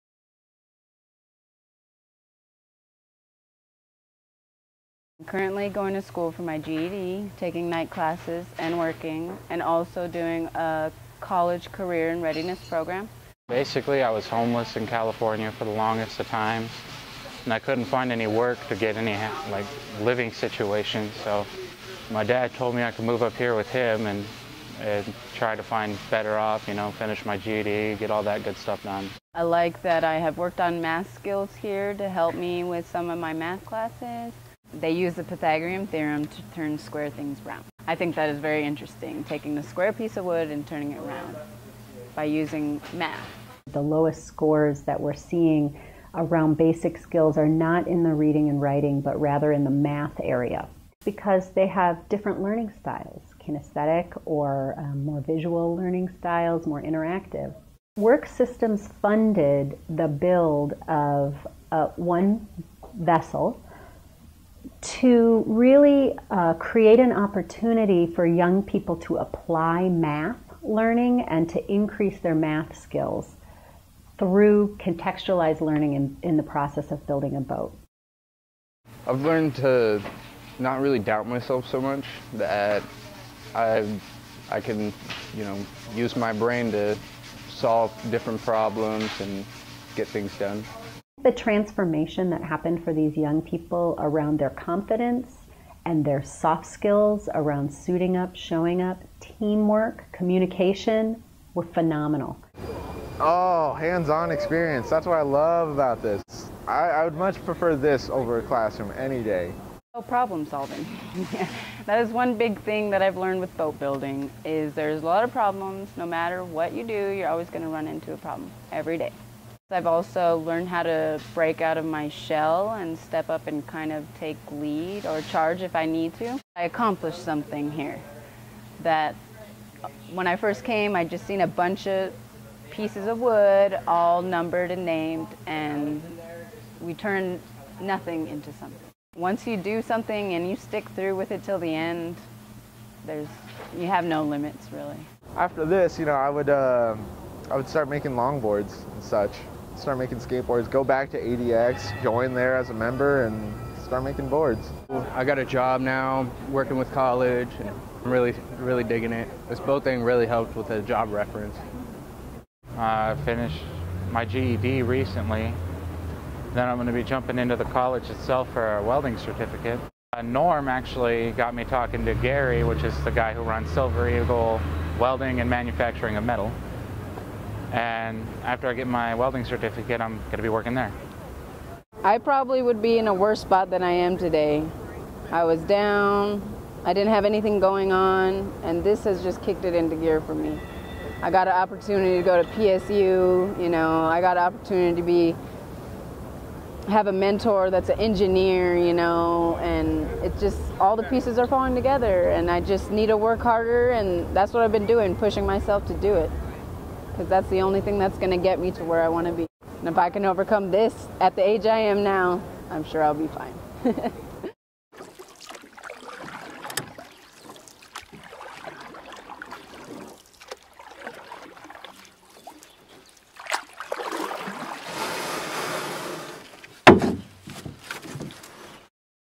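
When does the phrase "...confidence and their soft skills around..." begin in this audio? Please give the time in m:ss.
1:34.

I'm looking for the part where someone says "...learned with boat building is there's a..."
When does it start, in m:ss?
1:53.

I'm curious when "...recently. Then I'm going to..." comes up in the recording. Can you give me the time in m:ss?
2:44.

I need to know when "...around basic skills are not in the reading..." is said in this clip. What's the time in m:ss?
0:46.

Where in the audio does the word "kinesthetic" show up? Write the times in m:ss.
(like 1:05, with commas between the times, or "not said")
0:53.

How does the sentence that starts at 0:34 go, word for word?
They use the Pythagorean theorem to turn square things round.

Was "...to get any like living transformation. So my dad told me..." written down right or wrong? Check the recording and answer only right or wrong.
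wrong.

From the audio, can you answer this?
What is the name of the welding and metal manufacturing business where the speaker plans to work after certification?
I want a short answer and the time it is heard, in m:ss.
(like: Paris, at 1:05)
Silver Eagle Welding, at 2:53.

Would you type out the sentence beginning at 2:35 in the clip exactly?
I got a job now, working with college, and I'm really, really digging it.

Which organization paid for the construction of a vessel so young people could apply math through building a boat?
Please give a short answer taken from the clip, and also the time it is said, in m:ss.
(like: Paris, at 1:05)
Worksystems, at 0:57.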